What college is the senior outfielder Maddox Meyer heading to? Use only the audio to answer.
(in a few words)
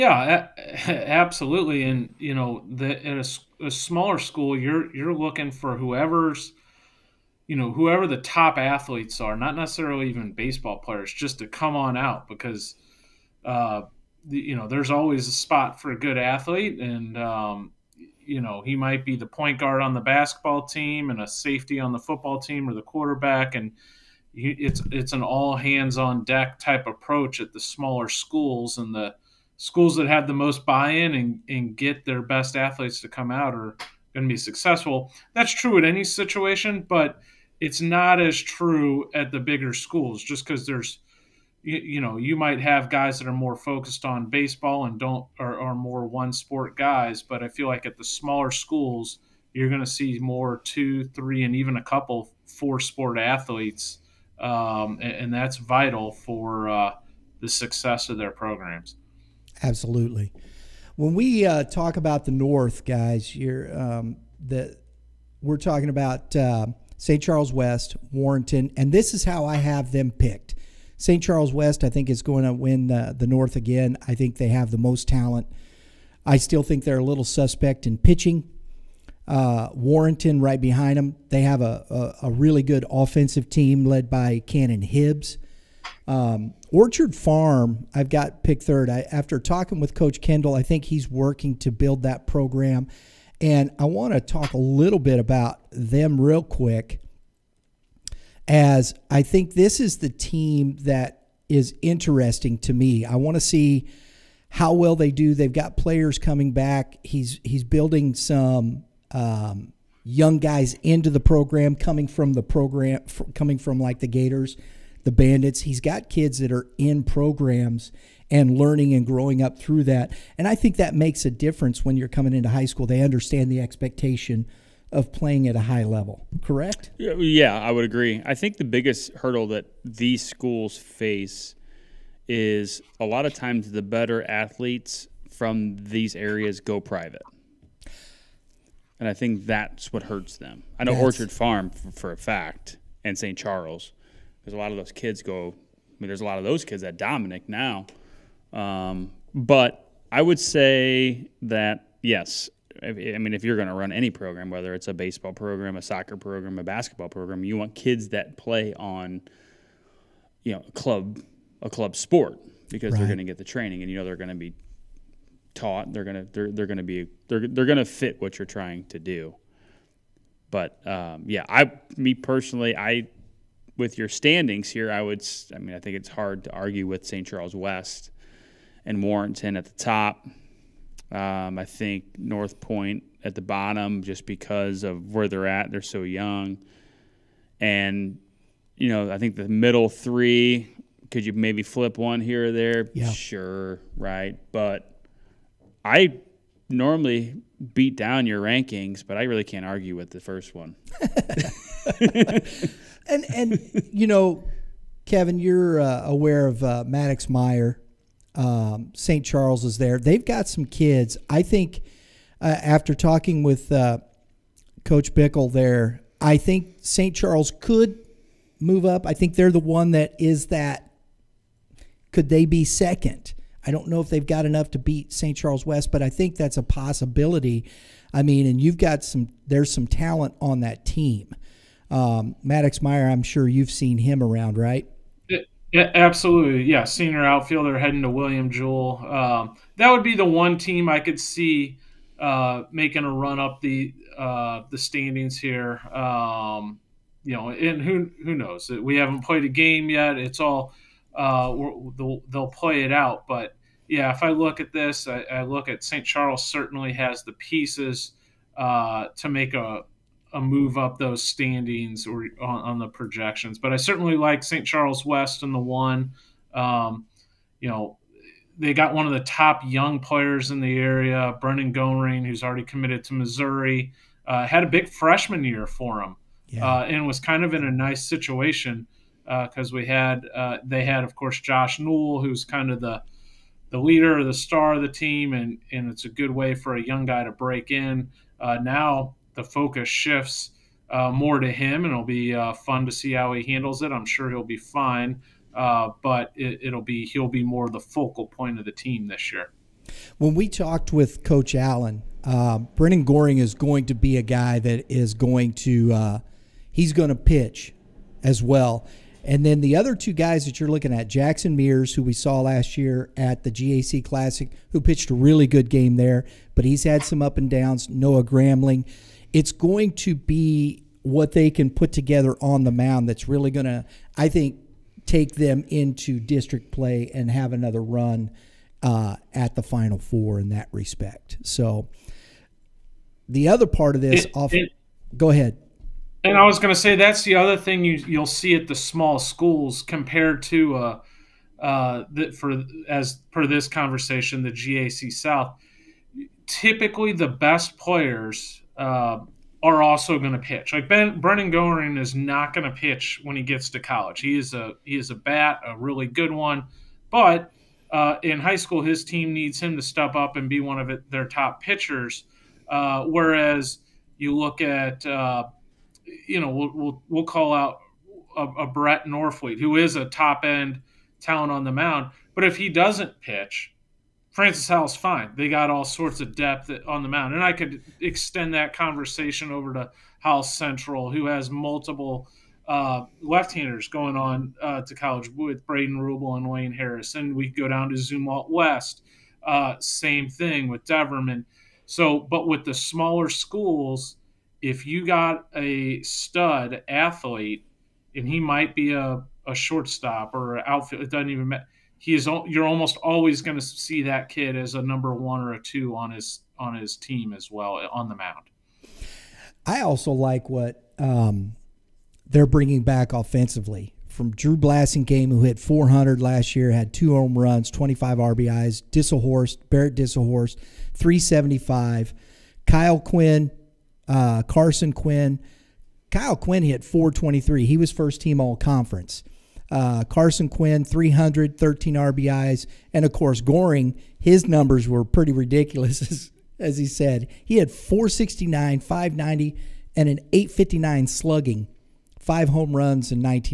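William Jewell.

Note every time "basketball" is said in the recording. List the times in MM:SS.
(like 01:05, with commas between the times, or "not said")
00:20, 02:36.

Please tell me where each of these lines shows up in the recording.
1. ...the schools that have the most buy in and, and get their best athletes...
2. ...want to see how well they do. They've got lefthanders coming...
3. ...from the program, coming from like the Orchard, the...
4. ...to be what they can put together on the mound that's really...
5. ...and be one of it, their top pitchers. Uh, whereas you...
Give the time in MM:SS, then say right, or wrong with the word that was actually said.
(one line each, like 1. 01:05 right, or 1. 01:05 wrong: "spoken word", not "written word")
1. 00:28 right
2. 01:43 wrong: "players", not "lefthanders"
3. 01:52 wrong: "Gators", not "Orchard"
4. 05:19 right
5. 06:00 right.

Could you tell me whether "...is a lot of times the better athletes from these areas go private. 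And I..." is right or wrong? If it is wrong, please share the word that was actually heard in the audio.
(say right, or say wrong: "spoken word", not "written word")
right.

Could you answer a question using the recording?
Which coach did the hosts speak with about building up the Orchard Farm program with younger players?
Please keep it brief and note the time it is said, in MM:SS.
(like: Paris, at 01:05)
Coach Kendall, at 01:29.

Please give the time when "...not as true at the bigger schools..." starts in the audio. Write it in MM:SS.
00:37.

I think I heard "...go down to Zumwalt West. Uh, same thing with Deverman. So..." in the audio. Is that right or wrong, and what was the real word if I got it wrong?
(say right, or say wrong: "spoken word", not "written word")
right.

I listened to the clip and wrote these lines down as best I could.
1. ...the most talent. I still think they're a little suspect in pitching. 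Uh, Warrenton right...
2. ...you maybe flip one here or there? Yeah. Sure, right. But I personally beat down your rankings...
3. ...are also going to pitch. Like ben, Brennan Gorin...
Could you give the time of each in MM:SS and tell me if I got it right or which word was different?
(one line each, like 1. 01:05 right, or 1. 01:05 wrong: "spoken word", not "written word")
1. 01:14 right
2. 03:11 wrong: "normally", not "personally"
3. 05:49 right.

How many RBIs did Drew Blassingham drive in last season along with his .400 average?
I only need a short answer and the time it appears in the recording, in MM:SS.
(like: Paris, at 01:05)
25, at 06:57.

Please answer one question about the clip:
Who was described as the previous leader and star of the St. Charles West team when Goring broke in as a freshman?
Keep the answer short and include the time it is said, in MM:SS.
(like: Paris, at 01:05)
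Josh Newell, at 04:41.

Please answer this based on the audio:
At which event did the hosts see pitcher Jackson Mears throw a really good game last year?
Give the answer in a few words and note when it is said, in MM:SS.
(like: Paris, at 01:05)
GAC Classic, at 05:13.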